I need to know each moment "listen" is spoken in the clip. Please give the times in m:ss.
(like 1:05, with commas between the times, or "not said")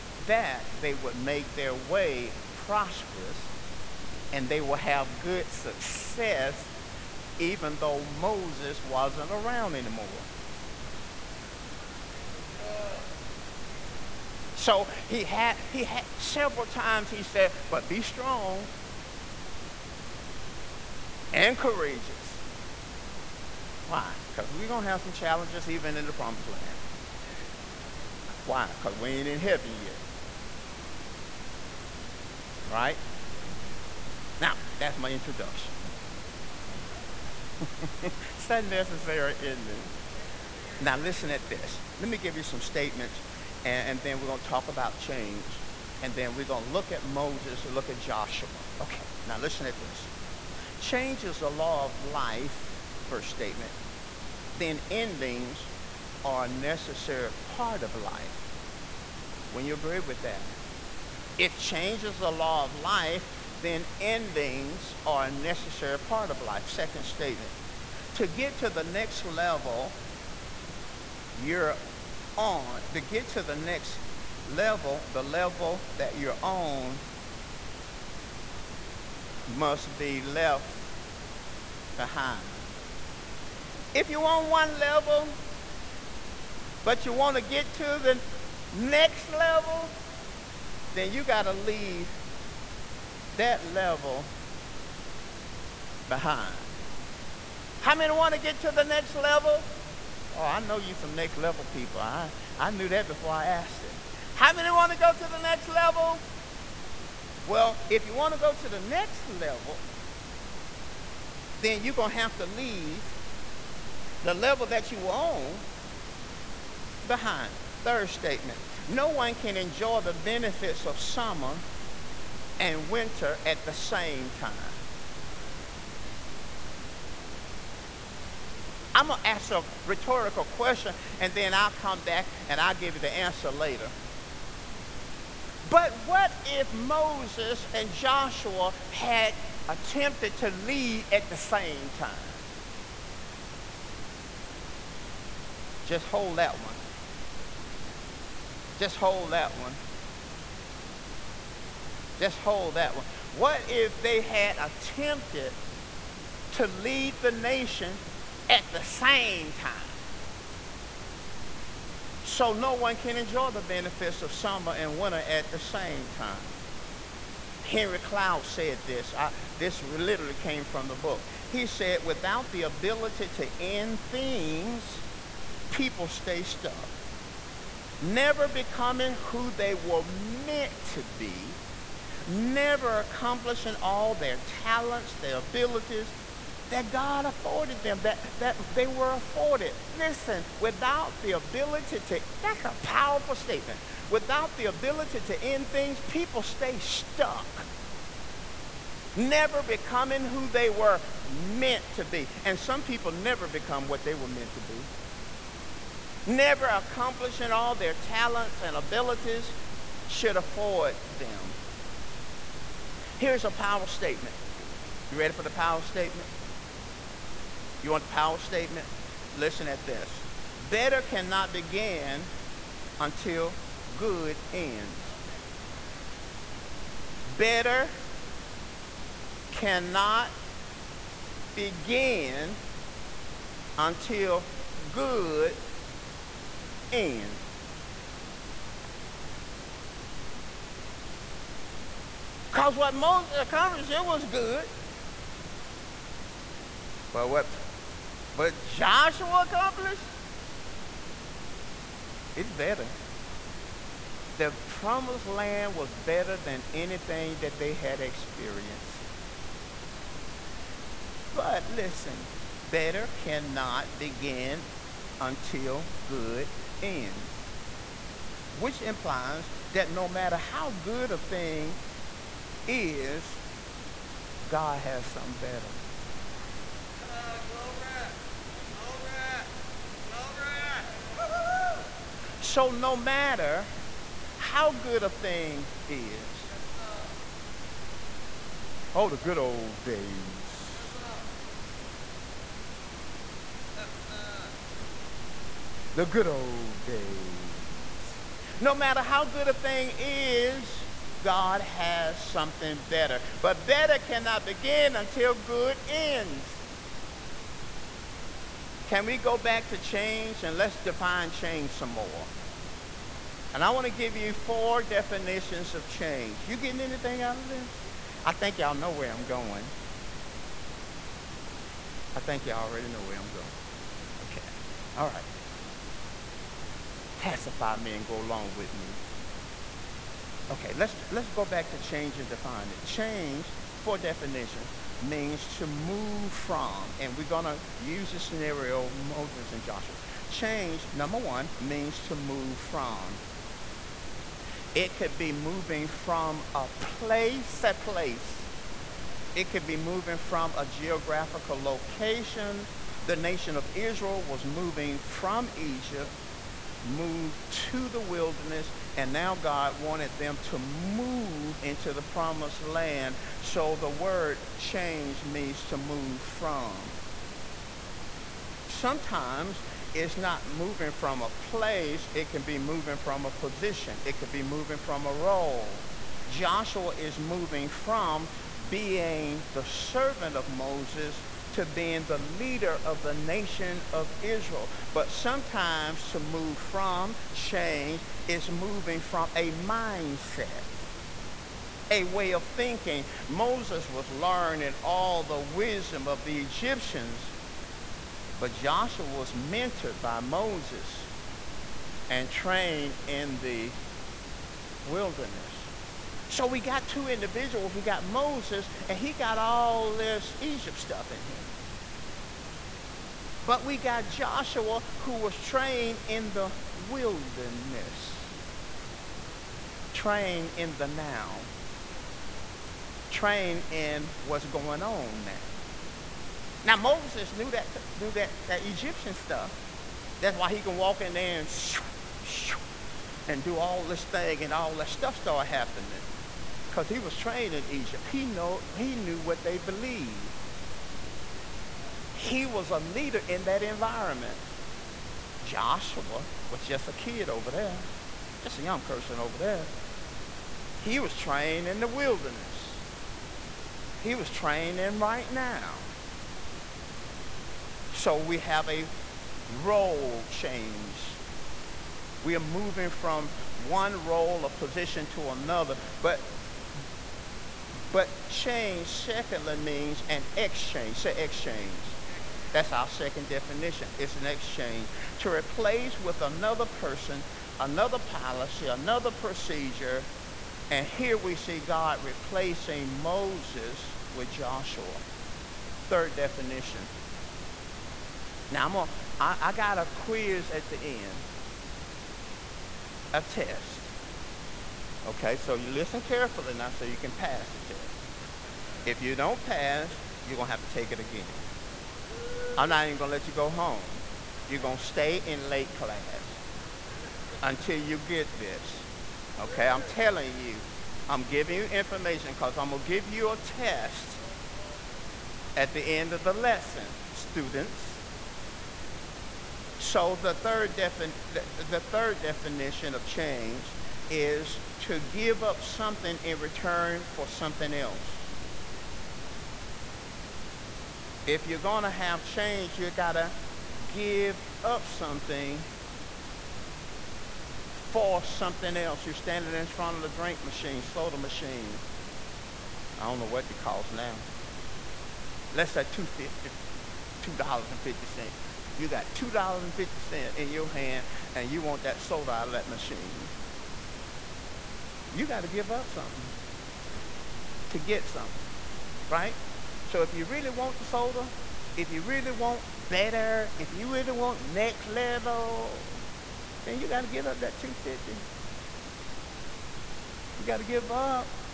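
0:40, 0:49, 3:09, 3:39, 4:21, 8:15.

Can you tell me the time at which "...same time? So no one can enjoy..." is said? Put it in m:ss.
2:38.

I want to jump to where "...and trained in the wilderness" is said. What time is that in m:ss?
6:42.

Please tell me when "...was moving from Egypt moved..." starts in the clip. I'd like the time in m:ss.
5:54.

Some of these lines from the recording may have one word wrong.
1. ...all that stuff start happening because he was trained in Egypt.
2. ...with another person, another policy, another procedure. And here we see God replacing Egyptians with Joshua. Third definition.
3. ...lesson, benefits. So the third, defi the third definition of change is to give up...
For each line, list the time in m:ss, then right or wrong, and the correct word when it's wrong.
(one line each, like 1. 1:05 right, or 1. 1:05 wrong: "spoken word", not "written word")
1. 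7:14 right
2. 7:55 wrong: "Moses", not "Egyptians"
3. 8:36 wrong: "students", not "benefits".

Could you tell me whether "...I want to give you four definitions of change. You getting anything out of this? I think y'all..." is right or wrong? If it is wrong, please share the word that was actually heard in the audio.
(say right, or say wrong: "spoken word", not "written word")
right.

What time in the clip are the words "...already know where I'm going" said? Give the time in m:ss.
5:22.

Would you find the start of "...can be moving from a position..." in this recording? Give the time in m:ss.
6:12.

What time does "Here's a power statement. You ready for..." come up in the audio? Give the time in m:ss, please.
3:33.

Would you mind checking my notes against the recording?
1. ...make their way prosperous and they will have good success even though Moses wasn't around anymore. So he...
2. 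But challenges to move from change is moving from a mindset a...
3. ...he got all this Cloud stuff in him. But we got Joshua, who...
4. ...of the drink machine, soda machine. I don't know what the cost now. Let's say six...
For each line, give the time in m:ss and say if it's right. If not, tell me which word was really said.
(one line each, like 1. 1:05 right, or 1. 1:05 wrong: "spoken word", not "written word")
1. 0:01 right
2. 6:24 wrong: "sometimes", not "challenges"
3. 6:48 wrong: "Egypt", not "Cloud"
4. 8:59 wrong: "two", not "six".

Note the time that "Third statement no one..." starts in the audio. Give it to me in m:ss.
1:57.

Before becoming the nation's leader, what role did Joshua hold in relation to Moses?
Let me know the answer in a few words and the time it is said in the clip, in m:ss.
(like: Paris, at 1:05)
Servant, at 6:19.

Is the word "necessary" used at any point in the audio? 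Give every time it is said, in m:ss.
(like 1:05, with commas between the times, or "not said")
0:38, 0:56, 1:05.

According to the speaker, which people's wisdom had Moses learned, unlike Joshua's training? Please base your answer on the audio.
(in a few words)
The Egyptians.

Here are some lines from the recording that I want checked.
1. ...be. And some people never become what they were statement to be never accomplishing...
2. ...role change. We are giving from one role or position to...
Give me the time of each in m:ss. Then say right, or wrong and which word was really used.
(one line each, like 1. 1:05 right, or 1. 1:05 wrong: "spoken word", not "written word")
1. 3:22 wrong: "meant", not "statement"
2. 7:39 wrong: "moving", not "giving".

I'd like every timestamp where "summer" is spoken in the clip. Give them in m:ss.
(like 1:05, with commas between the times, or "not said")
2:00, 2:44.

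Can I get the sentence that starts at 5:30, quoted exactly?
Okay, let's, let's go back to change and define it.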